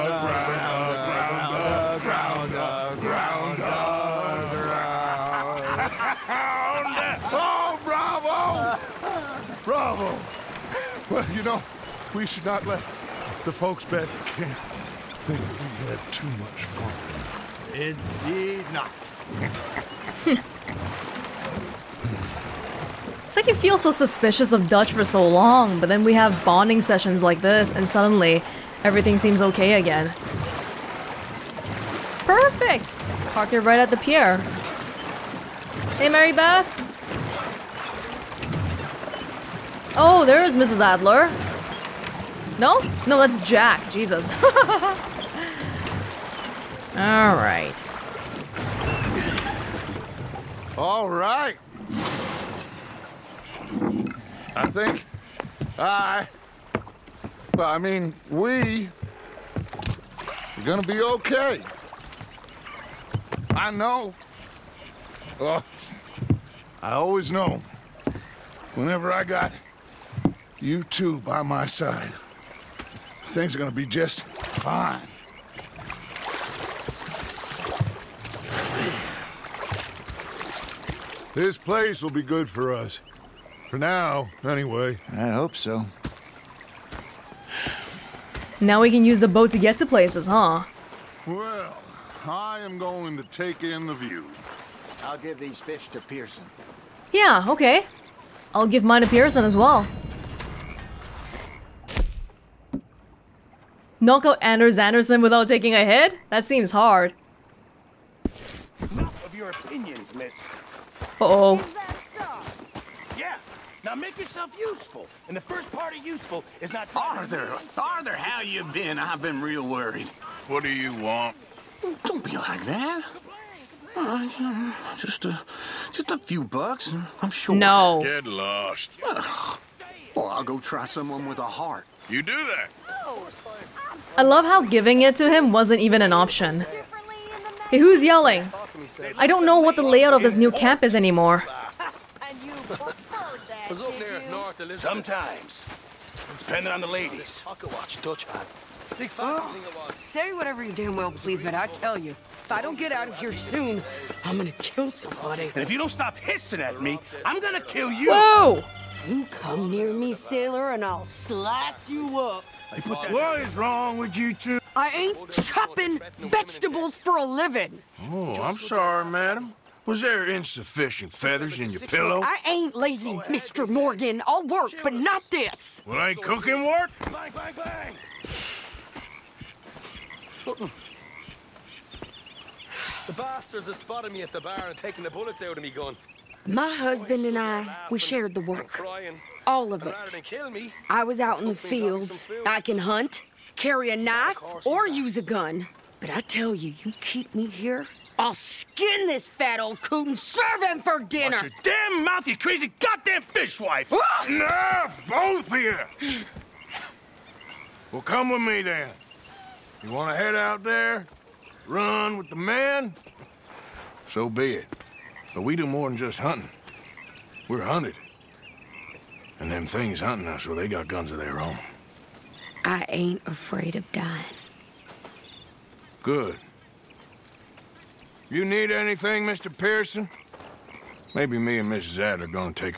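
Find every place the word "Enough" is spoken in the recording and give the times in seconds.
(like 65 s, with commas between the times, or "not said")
108 s, 204 s.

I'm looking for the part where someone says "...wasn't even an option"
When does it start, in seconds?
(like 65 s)
135 s.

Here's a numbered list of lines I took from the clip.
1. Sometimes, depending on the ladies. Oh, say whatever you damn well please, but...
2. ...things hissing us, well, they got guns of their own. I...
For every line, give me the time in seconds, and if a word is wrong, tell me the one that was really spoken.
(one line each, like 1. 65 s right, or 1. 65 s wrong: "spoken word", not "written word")
1. 144 s right
2. 219 s wrong: "hunting", not "hissing".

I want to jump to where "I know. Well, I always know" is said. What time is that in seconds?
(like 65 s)
63 s.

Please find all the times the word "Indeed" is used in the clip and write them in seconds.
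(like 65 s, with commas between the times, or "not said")
17 s.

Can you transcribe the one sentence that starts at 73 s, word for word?
Things are gonna be just fine.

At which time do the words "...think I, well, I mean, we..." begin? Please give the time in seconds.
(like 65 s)
54 s.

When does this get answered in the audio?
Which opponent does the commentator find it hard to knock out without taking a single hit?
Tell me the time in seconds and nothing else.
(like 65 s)
104 s.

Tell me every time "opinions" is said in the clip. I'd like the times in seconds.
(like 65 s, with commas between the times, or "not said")
109 s.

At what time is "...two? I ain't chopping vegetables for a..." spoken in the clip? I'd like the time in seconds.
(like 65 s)
164 s.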